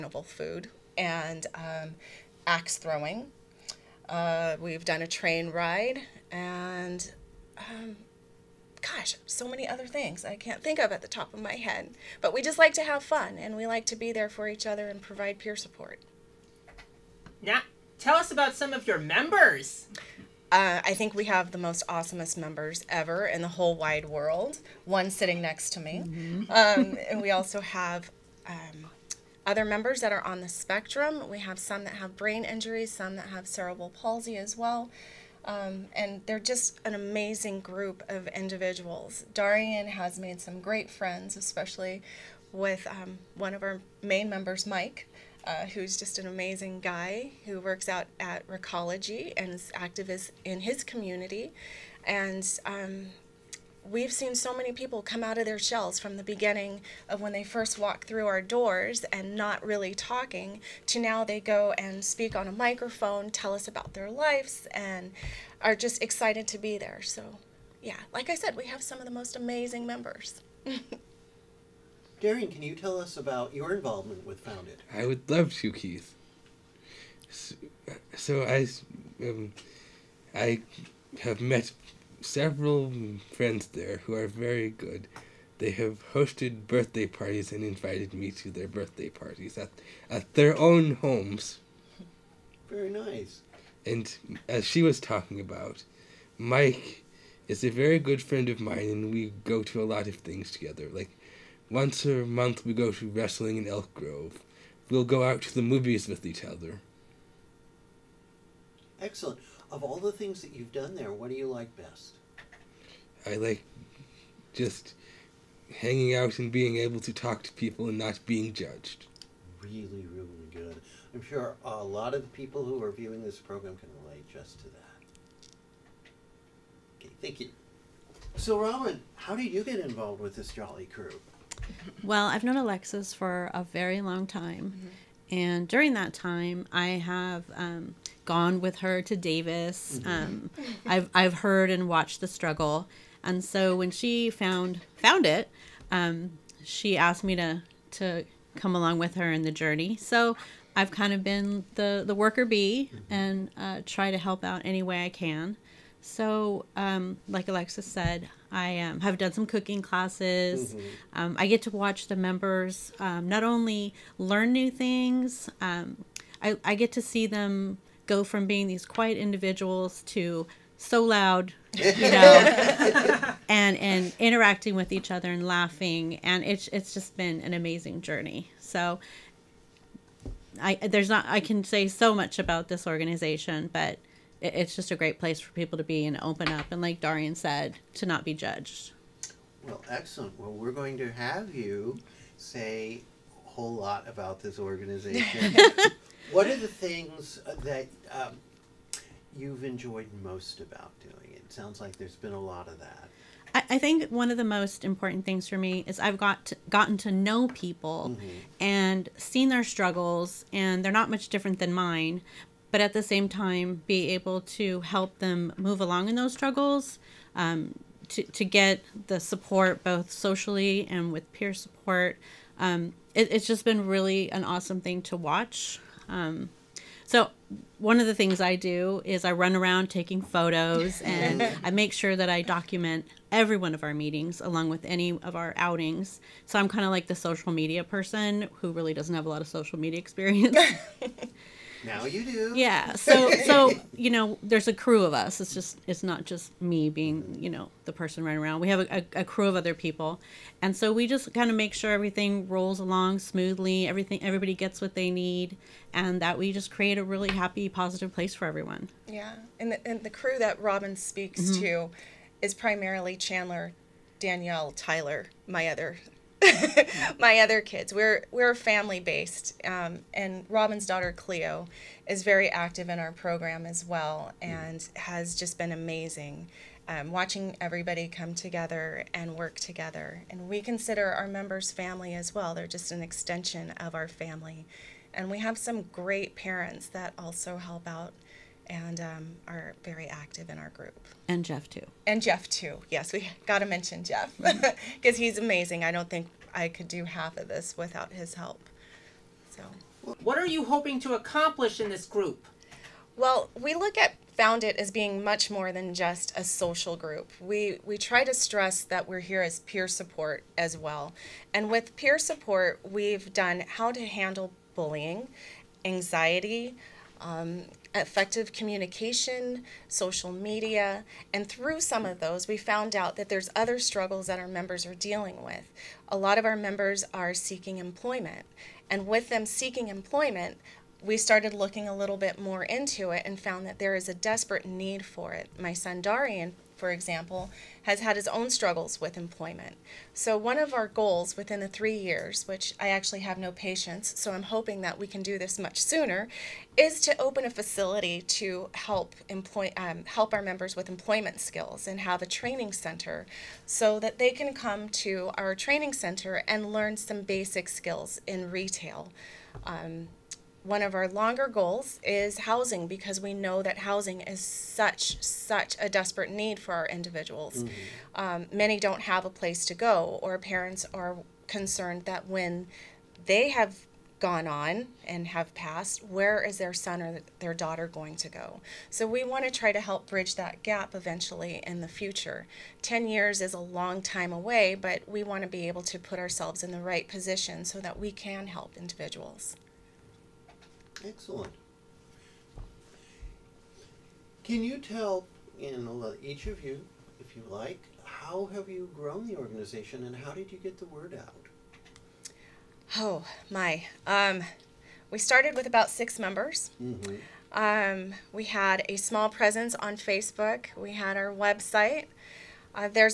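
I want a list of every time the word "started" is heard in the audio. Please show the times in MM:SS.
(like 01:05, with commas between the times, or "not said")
05:31, 06:45.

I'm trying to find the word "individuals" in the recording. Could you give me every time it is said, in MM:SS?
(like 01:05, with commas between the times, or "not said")
00:38, 02:49, 06:06, 06:28.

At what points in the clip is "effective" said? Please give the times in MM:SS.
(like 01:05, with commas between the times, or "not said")
05:17.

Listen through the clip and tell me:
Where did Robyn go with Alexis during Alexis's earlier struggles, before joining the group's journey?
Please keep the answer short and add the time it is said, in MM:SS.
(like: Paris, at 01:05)
Davis, at 02:19.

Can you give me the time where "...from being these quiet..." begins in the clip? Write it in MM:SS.
02:48.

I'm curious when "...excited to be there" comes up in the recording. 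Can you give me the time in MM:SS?
01:06.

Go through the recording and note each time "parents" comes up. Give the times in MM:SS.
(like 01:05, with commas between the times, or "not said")
04:46, 06:10.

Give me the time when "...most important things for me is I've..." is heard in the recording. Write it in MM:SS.
03:24.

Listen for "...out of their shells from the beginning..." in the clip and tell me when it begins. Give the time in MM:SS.
00:55.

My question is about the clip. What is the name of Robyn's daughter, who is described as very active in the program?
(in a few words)
Cleo.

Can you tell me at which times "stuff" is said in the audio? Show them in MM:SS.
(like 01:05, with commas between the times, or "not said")
not said.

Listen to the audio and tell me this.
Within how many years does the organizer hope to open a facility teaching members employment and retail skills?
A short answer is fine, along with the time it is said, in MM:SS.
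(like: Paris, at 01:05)
3, at 05:41.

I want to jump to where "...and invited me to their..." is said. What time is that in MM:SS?
01:27.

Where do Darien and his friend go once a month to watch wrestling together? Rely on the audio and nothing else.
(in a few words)
Elk Grove.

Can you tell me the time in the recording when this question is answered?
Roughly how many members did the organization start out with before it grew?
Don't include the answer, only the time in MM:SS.
06:45.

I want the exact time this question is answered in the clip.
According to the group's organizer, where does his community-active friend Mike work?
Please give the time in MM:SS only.
00:48.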